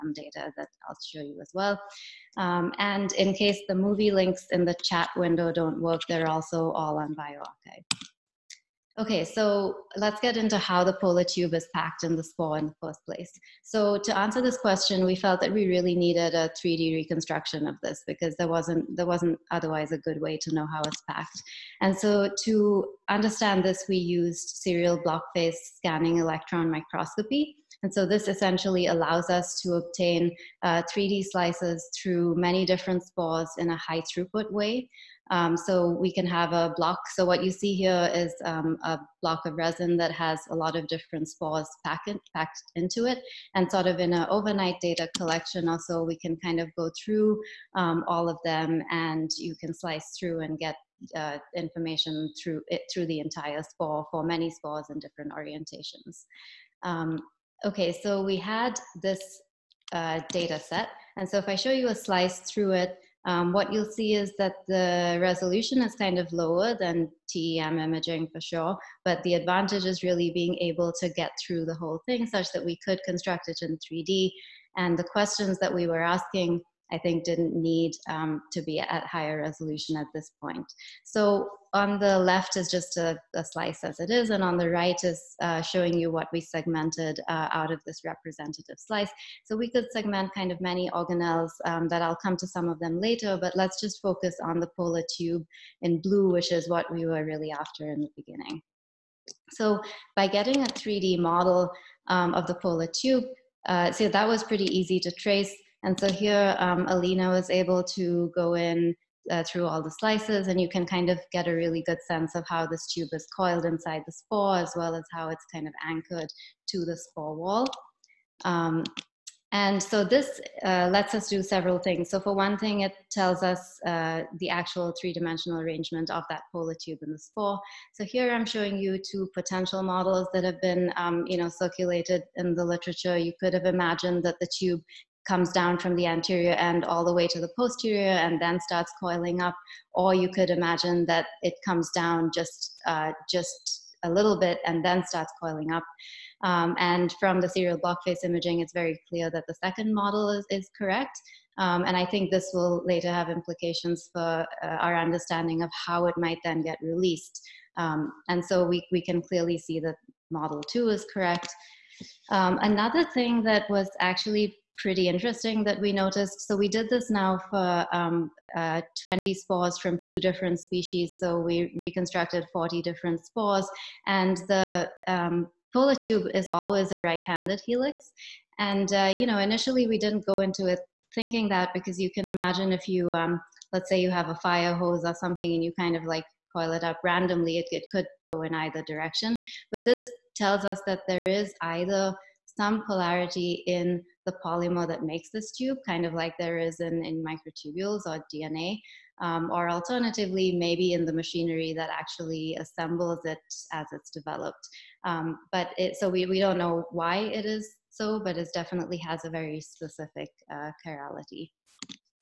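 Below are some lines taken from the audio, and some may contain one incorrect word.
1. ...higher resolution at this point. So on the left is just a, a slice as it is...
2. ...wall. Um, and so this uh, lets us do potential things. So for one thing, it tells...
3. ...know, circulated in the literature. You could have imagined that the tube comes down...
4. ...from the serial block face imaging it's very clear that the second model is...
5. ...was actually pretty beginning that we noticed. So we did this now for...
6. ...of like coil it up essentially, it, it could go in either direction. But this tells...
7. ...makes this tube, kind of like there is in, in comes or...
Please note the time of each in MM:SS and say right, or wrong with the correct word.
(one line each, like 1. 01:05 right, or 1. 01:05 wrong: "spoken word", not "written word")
1. 01:19 right
2. 01:57 wrong: "several", not "potential"
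3. 02:11 right
4. 02:27 right
5. 02:43 wrong: "interesting", not "beginning"
6. 03:05 wrong: "randomly", not "essentially"
7. 03:15 wrong: "microtubules", not "comes".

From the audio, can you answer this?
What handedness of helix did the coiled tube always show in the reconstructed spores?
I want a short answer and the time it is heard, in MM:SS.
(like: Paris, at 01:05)
Right-handed, at 02:57.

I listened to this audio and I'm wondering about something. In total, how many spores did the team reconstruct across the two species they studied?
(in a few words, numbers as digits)
40.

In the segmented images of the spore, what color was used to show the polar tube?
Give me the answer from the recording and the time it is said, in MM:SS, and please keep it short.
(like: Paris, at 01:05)
Blue, at 01:36.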